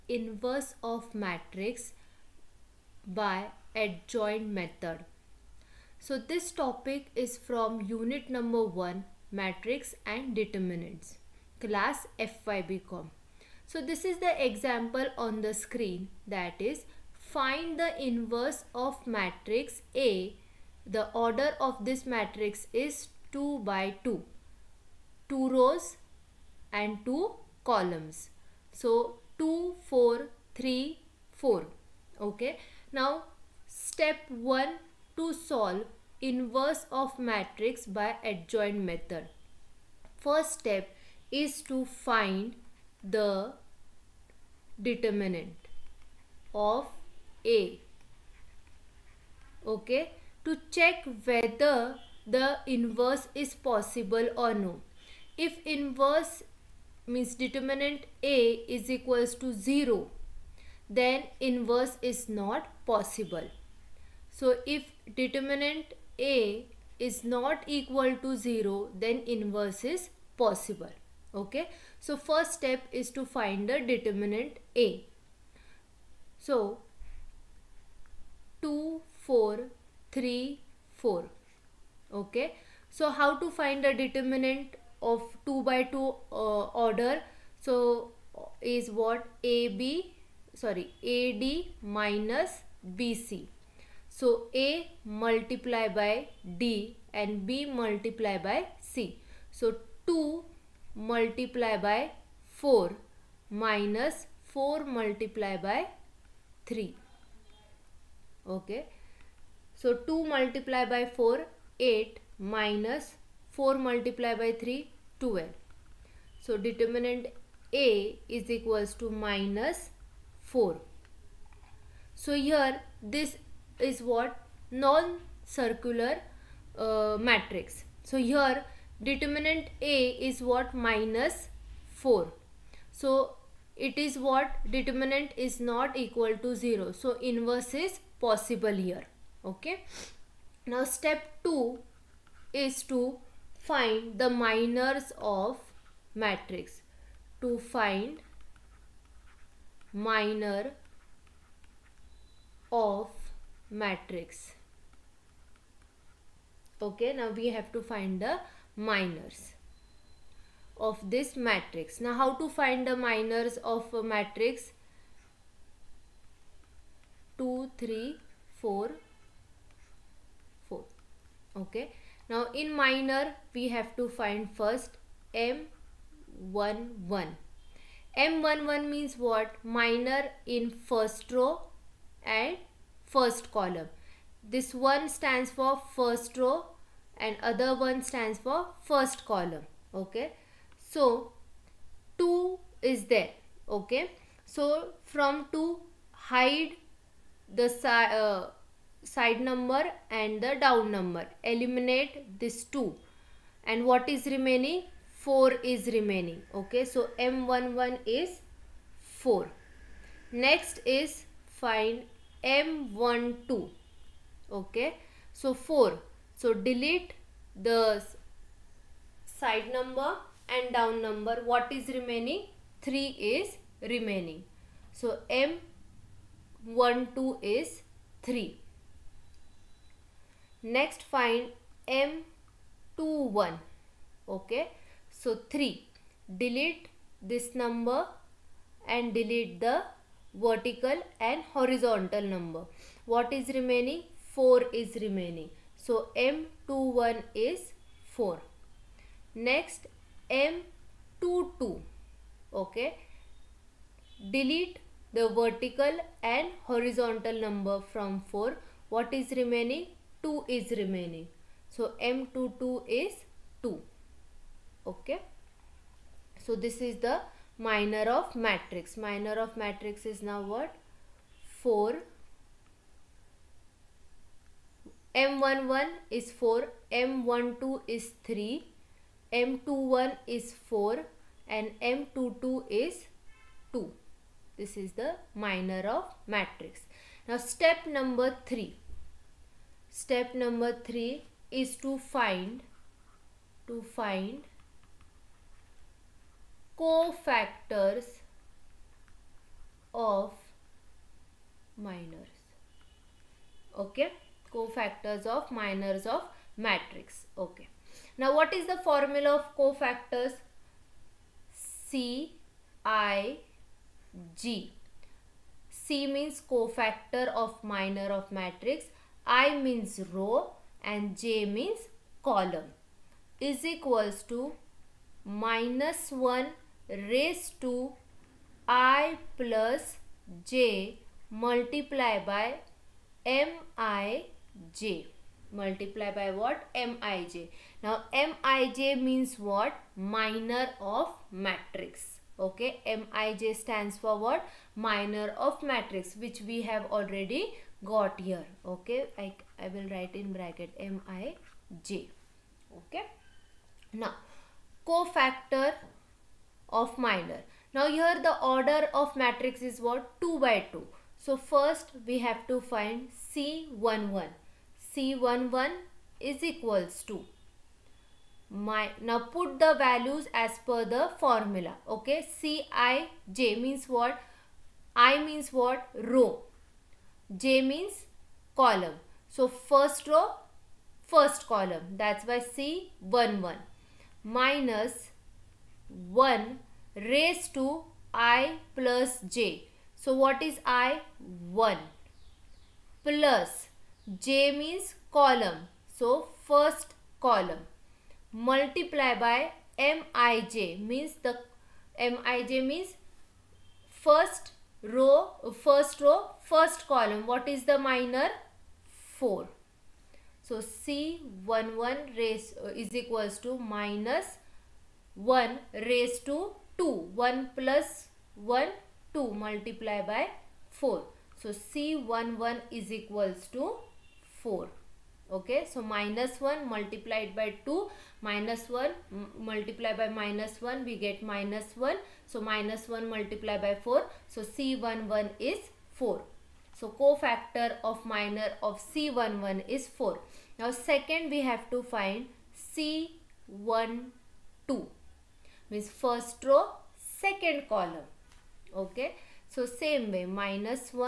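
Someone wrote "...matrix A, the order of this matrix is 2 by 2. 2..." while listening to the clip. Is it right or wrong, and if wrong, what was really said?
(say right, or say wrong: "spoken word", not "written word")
right.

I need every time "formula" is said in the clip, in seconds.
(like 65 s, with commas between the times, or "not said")
308 s, 371 s.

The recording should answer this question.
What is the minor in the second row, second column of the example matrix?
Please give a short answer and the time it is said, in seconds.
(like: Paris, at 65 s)
2, at 260 s.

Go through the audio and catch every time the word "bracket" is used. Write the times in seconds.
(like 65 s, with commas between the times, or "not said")
350 s.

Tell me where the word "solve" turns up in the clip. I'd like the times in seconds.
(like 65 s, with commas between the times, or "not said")
35 s.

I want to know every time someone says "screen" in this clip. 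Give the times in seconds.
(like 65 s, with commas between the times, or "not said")
15 s.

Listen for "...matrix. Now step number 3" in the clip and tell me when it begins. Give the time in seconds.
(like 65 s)
286 s.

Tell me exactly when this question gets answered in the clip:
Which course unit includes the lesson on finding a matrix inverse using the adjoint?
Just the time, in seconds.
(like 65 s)
7 s.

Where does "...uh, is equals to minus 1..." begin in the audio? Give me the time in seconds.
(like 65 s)
412 s.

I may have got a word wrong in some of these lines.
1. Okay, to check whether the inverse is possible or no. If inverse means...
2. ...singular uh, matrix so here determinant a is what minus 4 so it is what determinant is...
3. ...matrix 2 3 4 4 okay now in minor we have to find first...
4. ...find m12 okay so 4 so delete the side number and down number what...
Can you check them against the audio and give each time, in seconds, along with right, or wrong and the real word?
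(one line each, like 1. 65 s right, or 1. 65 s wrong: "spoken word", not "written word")
1. 49 s right
2. 125 s right
3. 164 s right
4. 211 s right.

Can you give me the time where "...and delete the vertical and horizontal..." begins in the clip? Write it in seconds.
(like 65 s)
238 s.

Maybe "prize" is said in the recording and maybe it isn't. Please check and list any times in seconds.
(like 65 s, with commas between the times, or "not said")
not said.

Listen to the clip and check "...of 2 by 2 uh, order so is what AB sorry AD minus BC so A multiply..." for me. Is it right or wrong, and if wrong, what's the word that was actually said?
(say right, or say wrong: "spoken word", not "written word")
right.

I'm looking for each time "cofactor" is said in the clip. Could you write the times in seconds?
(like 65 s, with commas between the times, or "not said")
296 s, 304 s, 309 s, 316 s, 354 s, 436 s.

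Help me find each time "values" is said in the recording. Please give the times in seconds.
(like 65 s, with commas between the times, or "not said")
369 s.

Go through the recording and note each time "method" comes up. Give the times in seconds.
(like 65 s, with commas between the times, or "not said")
4 s, 38 s.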